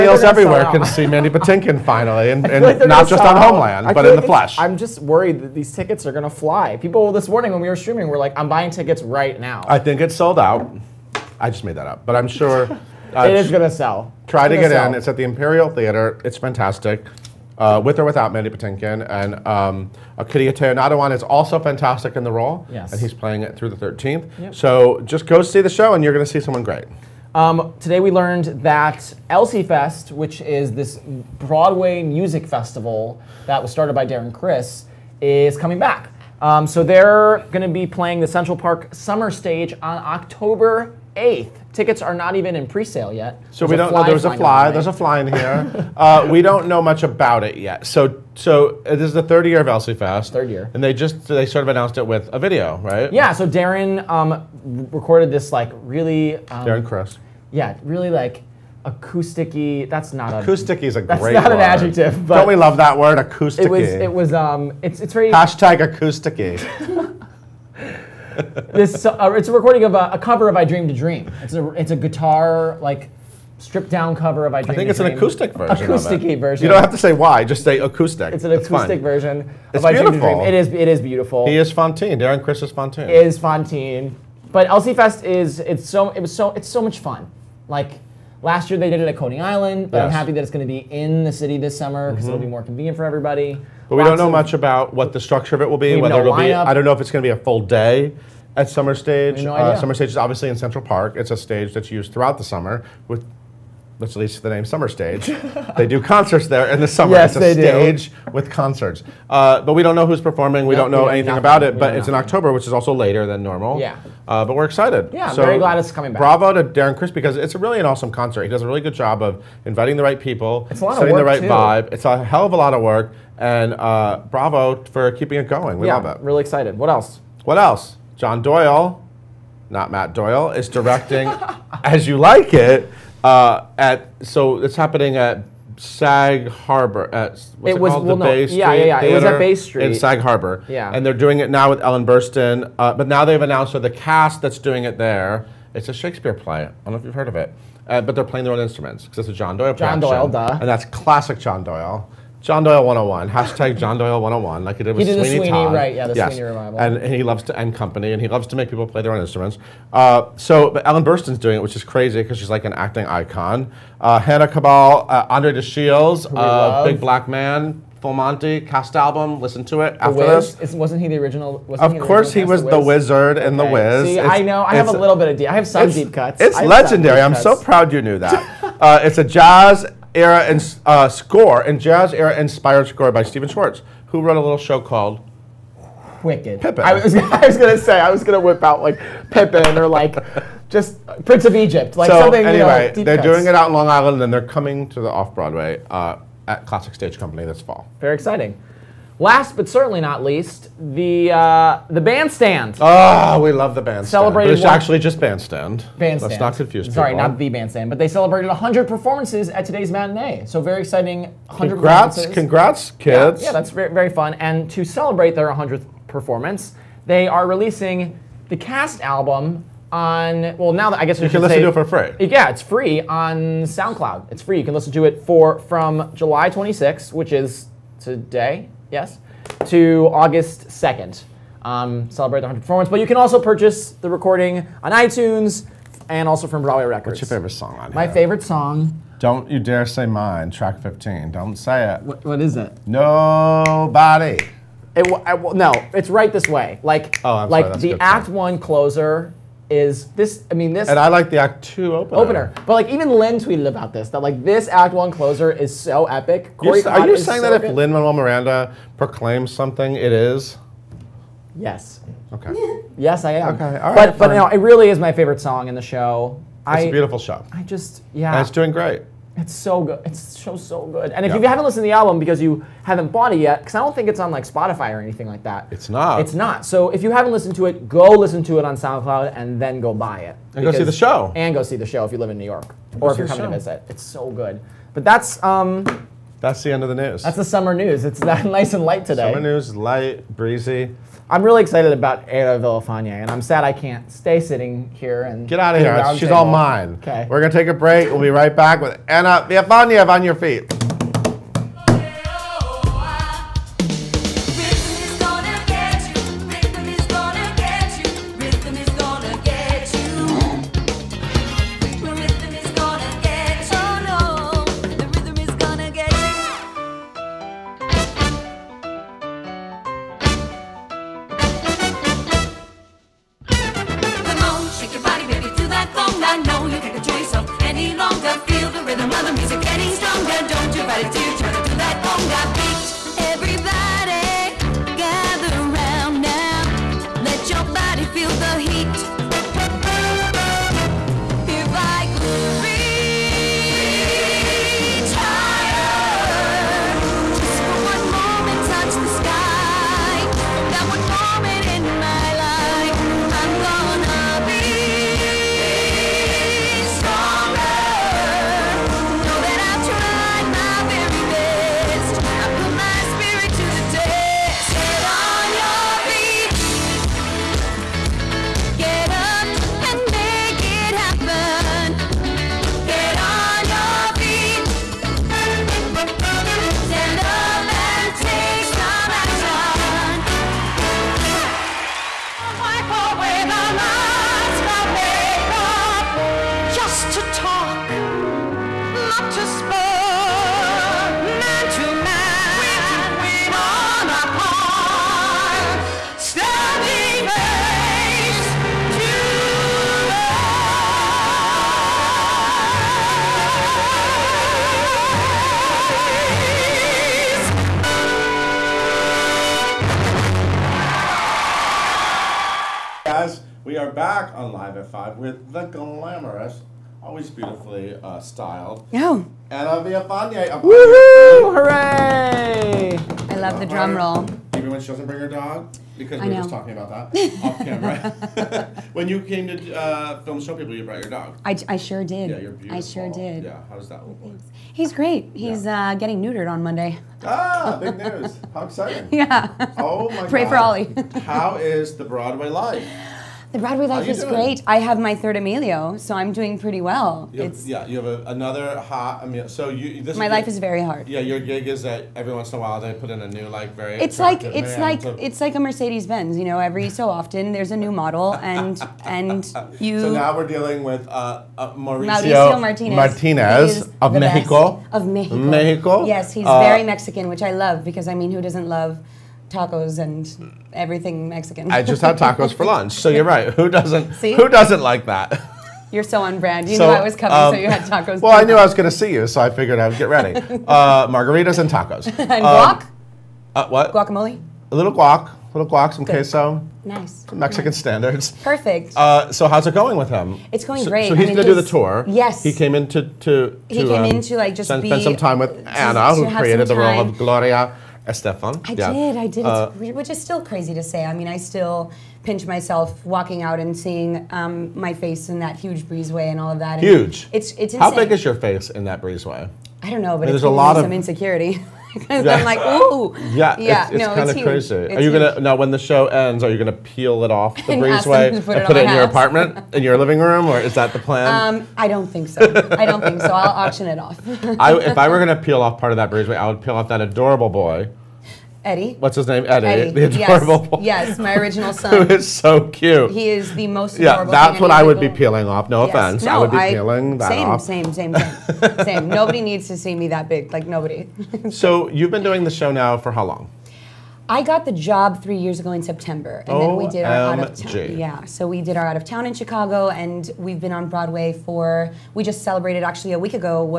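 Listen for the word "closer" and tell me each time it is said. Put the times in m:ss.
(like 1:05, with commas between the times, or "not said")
4:08, 4:15.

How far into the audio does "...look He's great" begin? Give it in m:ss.
7:14.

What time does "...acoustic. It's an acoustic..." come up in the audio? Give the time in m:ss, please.
1:17.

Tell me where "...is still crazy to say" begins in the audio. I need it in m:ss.
8:20.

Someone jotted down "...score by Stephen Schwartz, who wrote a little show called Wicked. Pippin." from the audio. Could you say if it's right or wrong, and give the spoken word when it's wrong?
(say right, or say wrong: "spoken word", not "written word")
right.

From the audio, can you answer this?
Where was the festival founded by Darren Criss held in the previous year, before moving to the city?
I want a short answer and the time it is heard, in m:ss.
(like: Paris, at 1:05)
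Coney Island, at 1:29.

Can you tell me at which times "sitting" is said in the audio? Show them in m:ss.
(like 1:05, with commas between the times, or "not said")
4:54.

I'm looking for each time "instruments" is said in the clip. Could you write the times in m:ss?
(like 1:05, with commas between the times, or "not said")
2:28, 2:39.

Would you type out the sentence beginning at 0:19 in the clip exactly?
And um, Okieriete Onaodowan is also fantastic in the role.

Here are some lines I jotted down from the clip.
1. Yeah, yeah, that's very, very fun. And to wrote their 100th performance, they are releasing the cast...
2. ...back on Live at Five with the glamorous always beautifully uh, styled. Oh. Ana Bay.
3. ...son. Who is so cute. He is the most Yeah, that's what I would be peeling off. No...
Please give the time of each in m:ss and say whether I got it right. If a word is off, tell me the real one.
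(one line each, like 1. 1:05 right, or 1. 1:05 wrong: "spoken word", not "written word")
1. 3:33 wrong: "celebrate", not "wrote"
2. 6:53 wrong: "Villafane", not "Bay"
3. 8:51 right.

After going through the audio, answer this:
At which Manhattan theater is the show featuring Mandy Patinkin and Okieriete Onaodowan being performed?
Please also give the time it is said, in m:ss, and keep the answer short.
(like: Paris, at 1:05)
Imperial Theater, at 0:15.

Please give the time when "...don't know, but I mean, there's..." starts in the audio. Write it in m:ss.
8:29.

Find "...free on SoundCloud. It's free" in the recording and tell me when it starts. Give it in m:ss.
3:42.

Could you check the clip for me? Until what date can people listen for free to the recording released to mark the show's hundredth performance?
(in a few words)
August 2nd.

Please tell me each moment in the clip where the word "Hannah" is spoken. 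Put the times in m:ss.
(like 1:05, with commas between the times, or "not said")
2:44.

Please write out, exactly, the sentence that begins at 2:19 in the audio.
it was at Bay Street in Sag Harbor.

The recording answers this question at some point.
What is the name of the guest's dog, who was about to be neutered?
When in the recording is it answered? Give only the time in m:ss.
7:20.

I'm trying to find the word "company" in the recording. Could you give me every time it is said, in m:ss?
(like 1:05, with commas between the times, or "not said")
2:37, 3:17.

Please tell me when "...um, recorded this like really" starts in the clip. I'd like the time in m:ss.
0:54.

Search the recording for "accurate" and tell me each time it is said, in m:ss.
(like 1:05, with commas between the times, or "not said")
not said.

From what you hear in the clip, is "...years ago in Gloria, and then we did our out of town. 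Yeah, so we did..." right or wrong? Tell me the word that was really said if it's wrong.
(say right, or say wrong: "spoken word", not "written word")
wrong: "September", not "Gloria".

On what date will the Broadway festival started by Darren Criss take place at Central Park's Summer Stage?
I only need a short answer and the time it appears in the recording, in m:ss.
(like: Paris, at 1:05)
October 8th, at 0:40.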